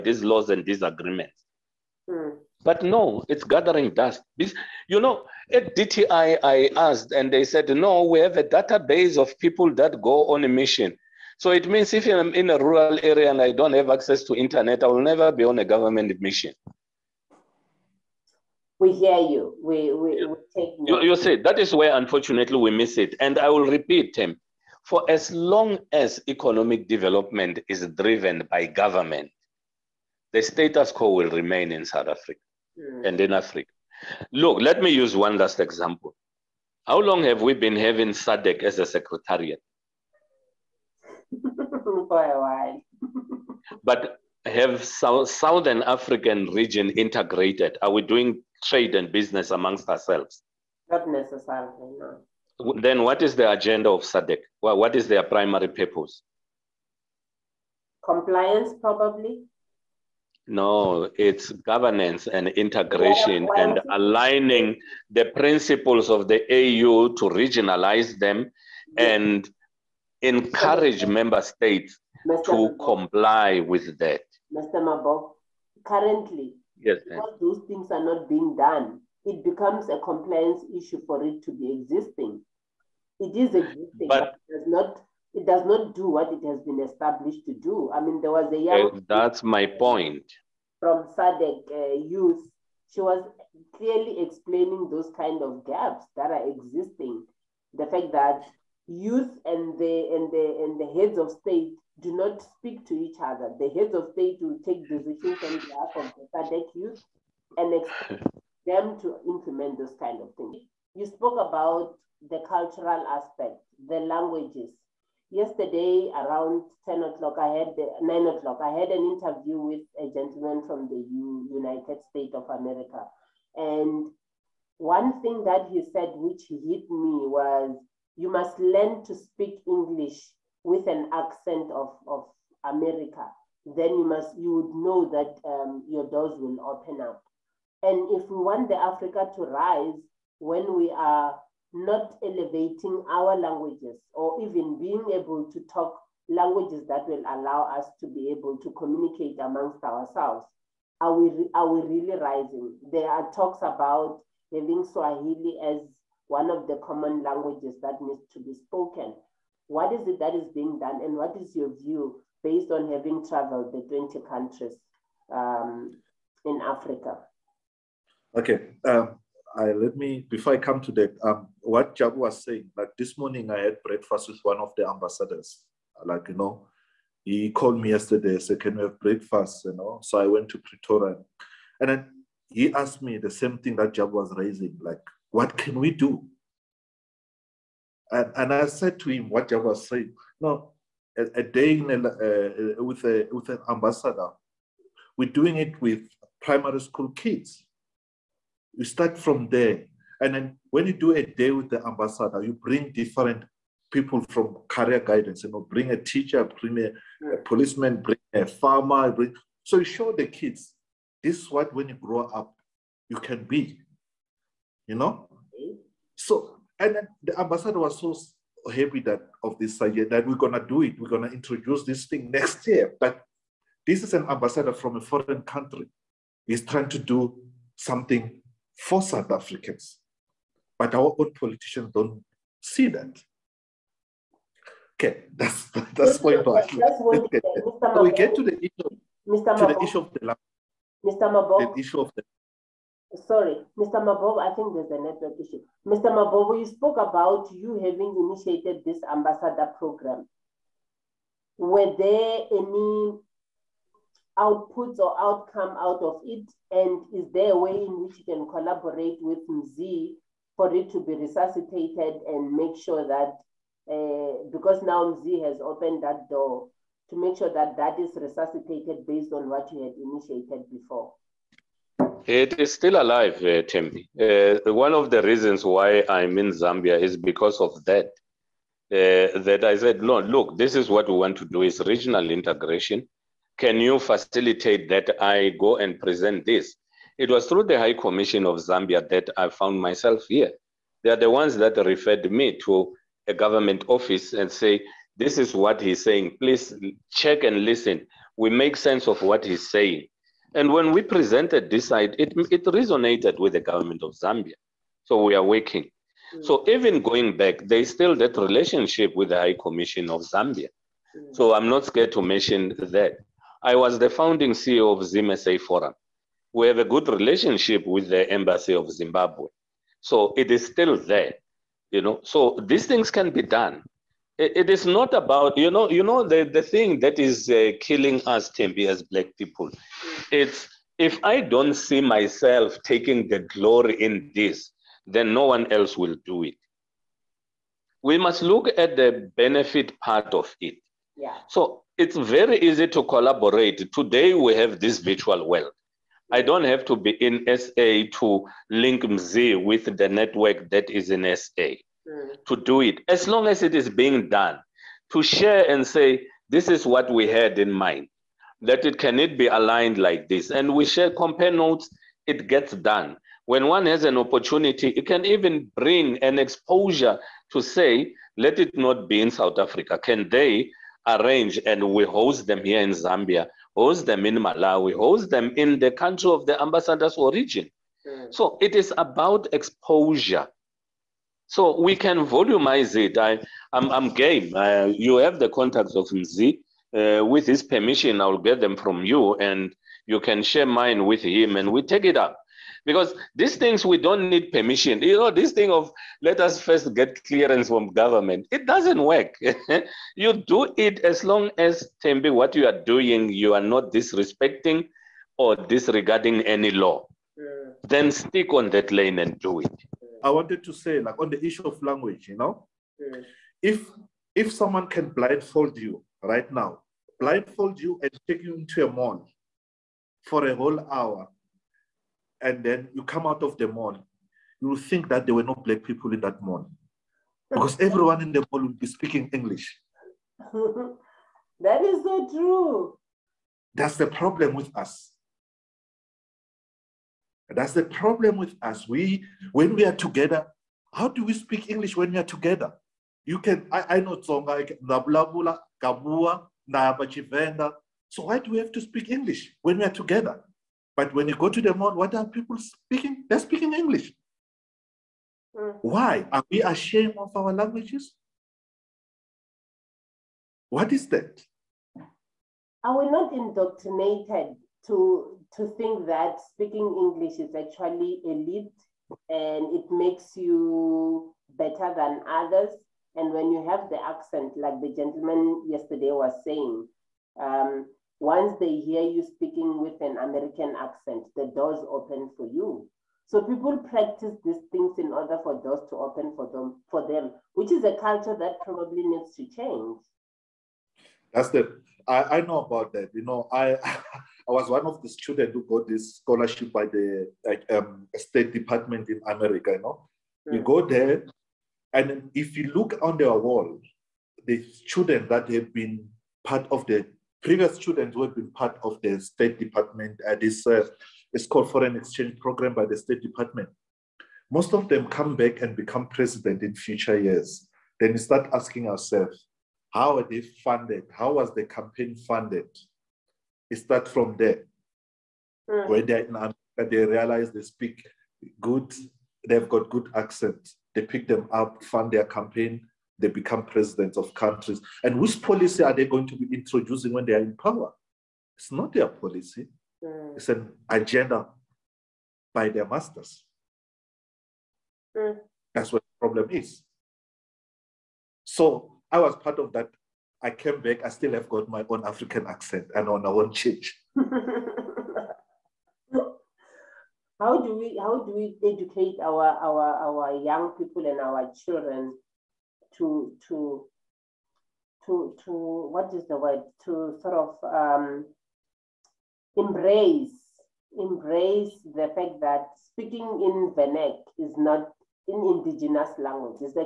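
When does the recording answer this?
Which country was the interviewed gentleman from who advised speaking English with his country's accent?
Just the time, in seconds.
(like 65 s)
121 s.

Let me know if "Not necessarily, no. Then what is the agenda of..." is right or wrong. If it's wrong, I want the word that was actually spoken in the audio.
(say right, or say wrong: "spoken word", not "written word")
right.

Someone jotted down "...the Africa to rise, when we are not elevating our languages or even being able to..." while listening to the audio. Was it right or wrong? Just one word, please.
right.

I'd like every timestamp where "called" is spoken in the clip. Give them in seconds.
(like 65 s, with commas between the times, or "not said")
177 s, 511 s.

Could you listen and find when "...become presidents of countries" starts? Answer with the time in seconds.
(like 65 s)
533 s.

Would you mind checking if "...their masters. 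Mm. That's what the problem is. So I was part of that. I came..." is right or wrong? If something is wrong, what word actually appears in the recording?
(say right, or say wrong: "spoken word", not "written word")
right.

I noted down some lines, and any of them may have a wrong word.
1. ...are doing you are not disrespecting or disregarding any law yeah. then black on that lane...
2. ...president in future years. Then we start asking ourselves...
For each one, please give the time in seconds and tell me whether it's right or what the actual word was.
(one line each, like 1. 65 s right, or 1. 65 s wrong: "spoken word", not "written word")
1. 402 s wrong: "stick", not "black"
2. 516 s right.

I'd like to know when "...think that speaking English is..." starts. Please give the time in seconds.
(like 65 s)
465 s.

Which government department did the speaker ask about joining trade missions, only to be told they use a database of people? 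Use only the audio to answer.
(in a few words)
DTI.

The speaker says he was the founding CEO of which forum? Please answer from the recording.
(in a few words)
ZMSA Forum.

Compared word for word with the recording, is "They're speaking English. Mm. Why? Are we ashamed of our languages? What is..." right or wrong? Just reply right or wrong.
right.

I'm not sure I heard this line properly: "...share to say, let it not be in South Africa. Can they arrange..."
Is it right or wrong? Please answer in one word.
wrong.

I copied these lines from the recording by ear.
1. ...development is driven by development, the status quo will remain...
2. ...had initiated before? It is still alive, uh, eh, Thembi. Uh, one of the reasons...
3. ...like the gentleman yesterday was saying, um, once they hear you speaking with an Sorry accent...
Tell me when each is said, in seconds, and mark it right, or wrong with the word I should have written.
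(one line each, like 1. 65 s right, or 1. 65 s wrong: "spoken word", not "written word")
1. 26 s wrong: "government", not "development"
2. 269 s right
3. 474 s wrong: "American", not "Sorry".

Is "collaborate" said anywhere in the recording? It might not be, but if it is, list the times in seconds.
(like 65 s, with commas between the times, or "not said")
258 s, 343 s.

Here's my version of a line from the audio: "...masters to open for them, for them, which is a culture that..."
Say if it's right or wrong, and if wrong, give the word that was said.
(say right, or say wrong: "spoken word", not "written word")
wrong: "doors", not "masters".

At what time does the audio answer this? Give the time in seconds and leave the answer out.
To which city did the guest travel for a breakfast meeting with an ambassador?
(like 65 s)
180 s.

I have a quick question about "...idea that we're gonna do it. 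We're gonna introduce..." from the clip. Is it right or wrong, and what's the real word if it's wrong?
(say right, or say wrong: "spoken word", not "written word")
right.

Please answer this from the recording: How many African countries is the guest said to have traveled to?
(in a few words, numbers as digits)
20.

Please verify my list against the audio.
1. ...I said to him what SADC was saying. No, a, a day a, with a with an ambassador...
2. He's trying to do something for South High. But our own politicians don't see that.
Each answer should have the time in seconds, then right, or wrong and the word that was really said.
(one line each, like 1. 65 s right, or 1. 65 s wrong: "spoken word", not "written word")
1. 188 s wrong: "Jabu", not "SADC"
2. 226 s wrong: "Africans", not "High".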